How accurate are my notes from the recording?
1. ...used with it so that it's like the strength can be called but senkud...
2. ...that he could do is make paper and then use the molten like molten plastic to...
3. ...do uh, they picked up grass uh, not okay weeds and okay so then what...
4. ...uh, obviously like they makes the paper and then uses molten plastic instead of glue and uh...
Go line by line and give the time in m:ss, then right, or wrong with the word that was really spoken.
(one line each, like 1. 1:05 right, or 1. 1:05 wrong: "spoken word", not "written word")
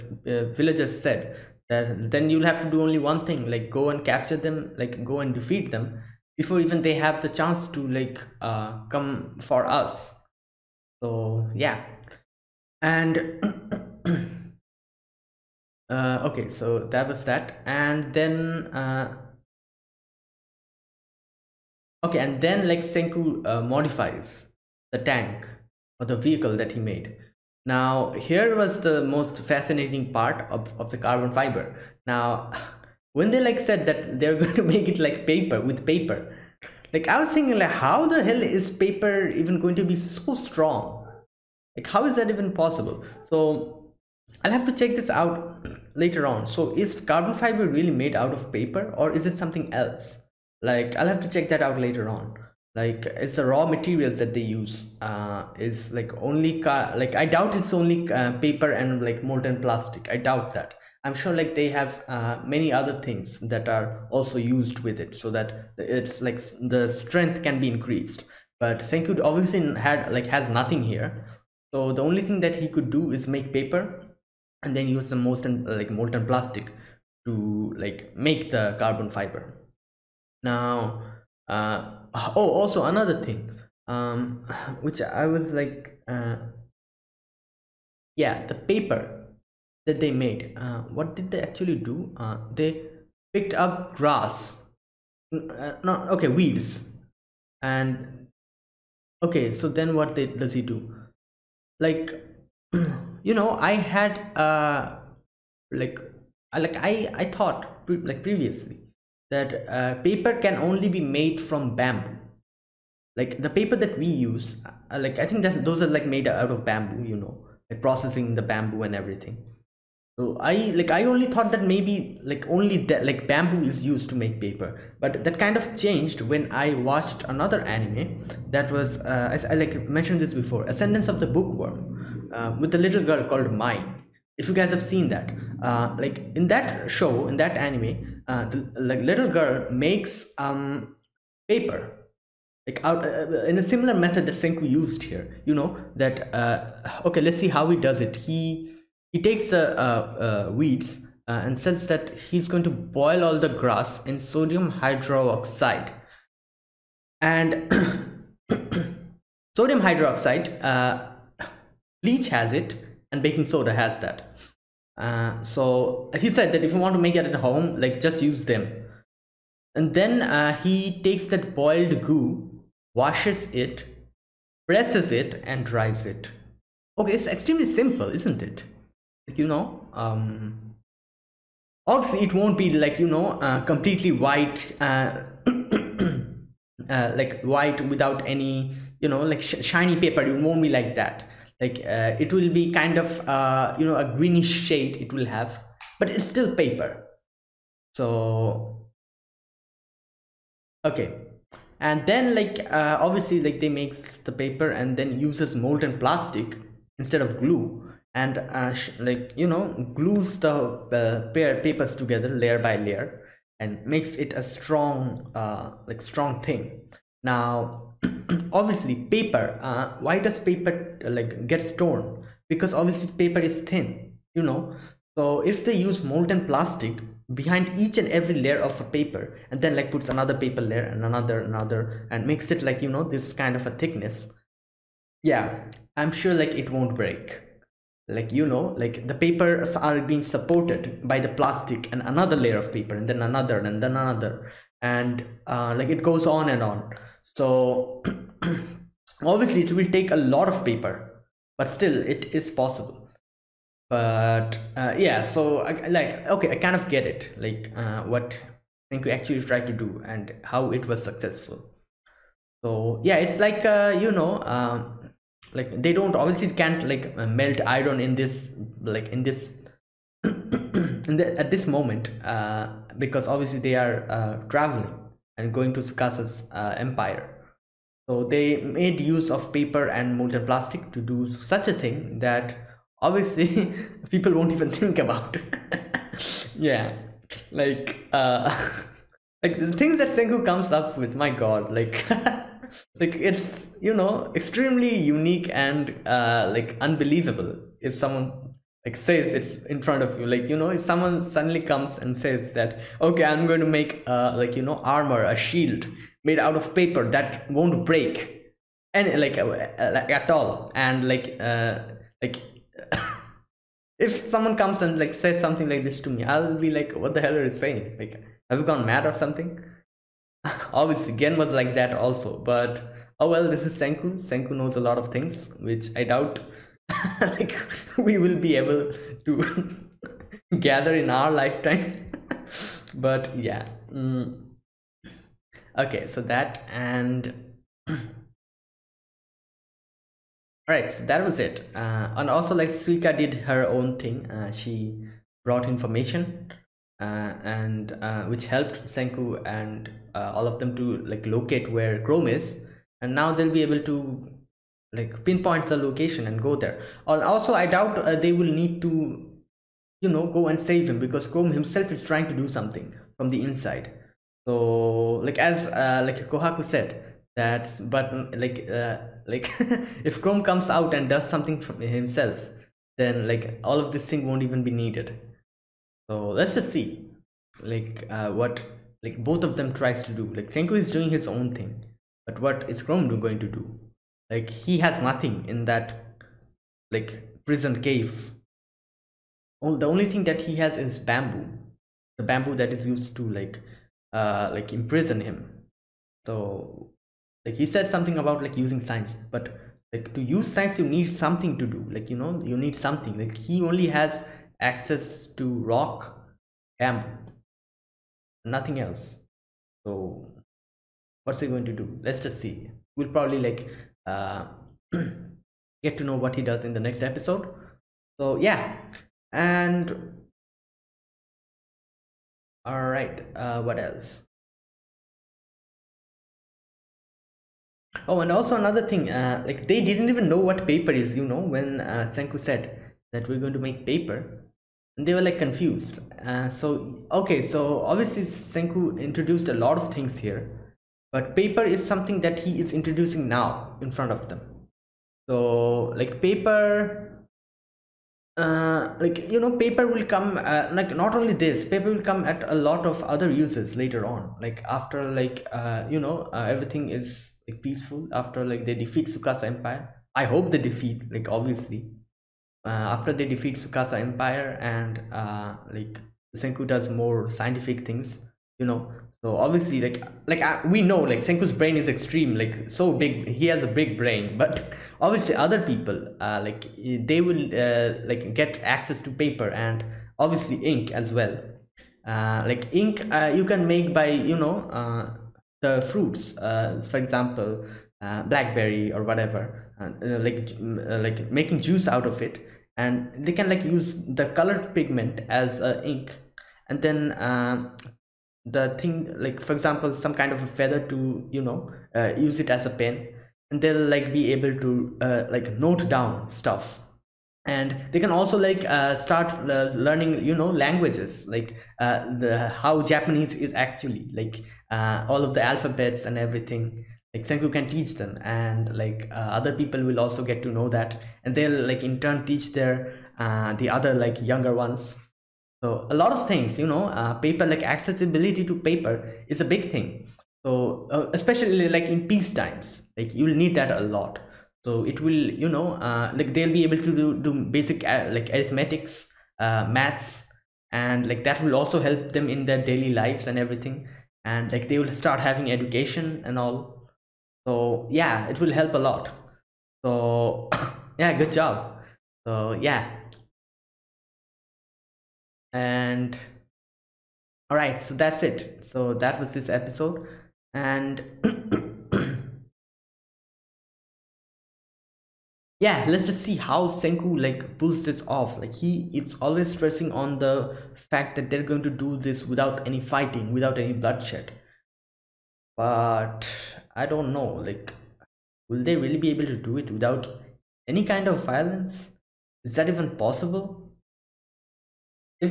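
1. 1:04 wrong: "increased", not "called"
2. 1:12 right
3. 1:31 right
4. 3:22 right.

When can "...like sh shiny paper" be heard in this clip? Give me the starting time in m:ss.
3:09.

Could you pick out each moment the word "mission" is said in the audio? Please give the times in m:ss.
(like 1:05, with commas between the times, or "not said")
not said.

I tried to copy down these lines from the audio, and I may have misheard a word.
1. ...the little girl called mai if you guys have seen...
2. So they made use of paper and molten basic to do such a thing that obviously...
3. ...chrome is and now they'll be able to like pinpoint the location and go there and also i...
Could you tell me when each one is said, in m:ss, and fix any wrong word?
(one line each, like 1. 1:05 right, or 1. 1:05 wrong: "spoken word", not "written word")
1. 2:12 right
2. 4:38 wrong: "plastic", not "basic"
3. 5:52 right.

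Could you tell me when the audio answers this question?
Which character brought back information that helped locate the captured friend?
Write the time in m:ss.
5:42.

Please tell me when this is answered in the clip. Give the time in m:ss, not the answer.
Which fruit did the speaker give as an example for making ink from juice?
8:08.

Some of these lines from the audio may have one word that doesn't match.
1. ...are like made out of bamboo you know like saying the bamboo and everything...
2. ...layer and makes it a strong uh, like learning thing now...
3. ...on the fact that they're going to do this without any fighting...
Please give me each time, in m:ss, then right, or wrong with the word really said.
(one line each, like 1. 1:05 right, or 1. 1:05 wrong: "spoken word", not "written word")
1. 1:55 wrong: "processing", not "saying"
2. 3:32 wrong: "strong", not "learning"
3. 9:29 right.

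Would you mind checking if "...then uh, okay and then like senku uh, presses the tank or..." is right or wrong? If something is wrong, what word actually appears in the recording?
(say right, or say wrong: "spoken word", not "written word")
wrong: "modifies", not "presses".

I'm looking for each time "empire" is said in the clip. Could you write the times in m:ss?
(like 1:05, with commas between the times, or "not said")
4:36, 7:39, 7:43.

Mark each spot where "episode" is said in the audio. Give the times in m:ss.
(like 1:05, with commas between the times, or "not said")
6:57, 9:19.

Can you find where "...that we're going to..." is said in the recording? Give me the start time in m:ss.
7:13.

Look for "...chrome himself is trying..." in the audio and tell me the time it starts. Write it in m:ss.
6:01.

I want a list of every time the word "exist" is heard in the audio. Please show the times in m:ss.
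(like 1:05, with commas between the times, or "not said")
not said.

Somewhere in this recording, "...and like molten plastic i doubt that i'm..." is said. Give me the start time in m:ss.
0:58.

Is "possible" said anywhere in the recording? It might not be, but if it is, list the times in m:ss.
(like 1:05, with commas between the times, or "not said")
0:42, 4:12, 9:42.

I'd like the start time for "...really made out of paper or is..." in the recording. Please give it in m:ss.
0:47.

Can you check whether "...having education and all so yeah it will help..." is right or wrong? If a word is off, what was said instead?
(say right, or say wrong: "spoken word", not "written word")
right.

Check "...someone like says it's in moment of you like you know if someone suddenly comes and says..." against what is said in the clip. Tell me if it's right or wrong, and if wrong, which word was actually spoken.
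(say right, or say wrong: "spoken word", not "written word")
wrong: "front", not "moment".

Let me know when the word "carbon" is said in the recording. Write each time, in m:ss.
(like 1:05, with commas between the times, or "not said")
0:30, 0:47, 1:18.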